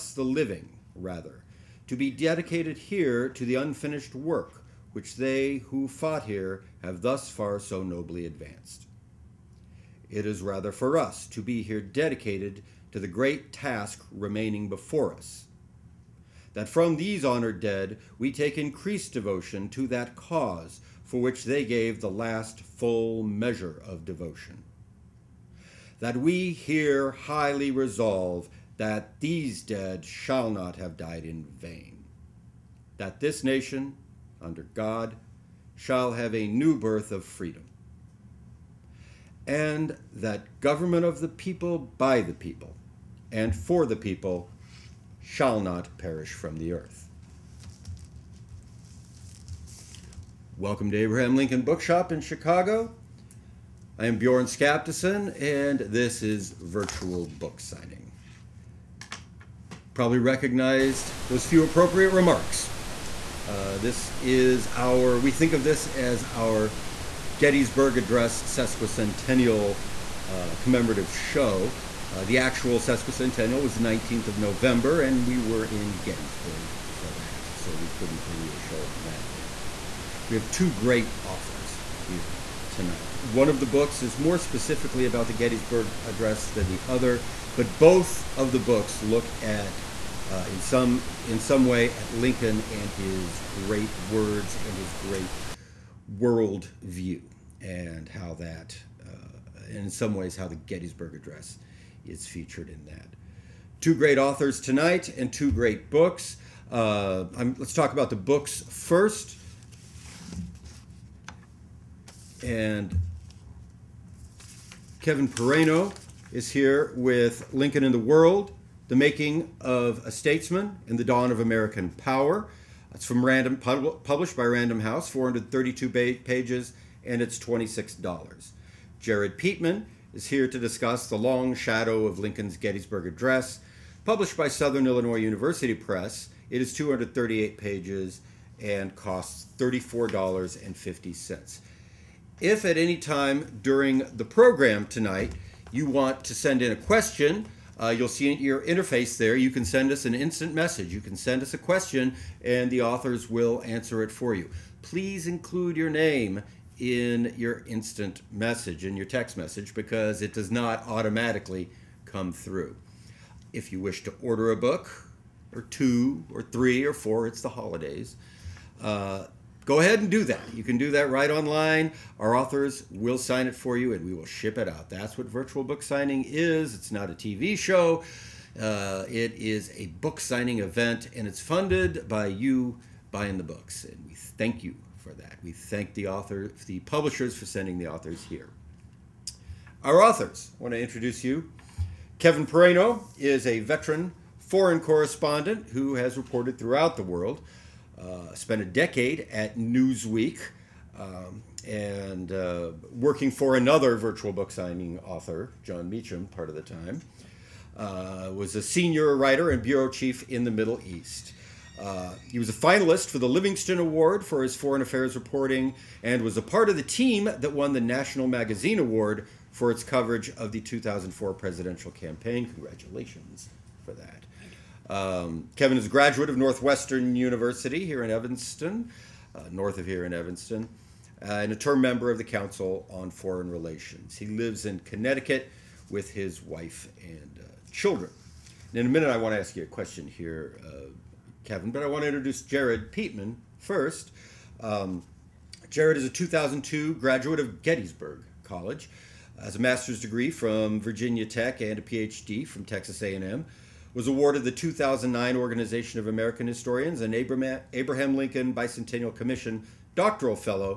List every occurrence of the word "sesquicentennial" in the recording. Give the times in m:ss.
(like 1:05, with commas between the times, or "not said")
1:08, 1:12.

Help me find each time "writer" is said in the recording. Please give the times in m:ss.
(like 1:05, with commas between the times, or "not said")
3:29.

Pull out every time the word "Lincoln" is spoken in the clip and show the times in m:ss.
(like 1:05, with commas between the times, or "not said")
0:51, 1:32, 1:57, 2:12, 4:18.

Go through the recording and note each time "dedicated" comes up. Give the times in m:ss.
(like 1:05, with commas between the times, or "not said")
0:02, 0:11.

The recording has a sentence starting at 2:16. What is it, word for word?
It is 238 pages and costs $34.50.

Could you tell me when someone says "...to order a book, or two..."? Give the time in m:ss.
2:44.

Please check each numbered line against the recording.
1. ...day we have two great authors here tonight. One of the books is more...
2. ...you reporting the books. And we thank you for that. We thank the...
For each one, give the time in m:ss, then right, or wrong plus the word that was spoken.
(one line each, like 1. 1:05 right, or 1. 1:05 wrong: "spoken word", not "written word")
1. 1:19 right
2. 3:02 wrong: "buying", not "reporting".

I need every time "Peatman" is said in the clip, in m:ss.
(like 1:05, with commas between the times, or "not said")
2:09, 4:02.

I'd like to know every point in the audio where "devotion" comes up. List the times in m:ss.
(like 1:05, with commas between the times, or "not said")
0:19, 0:24.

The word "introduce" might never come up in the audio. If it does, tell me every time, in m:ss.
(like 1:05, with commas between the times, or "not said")
3:10, 4:02.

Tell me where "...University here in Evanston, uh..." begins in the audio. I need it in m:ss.
3:47.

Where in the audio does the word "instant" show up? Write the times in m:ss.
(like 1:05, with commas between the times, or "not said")
2:30, 2:37.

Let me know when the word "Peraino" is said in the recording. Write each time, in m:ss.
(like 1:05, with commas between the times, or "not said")
1:55, 3:12.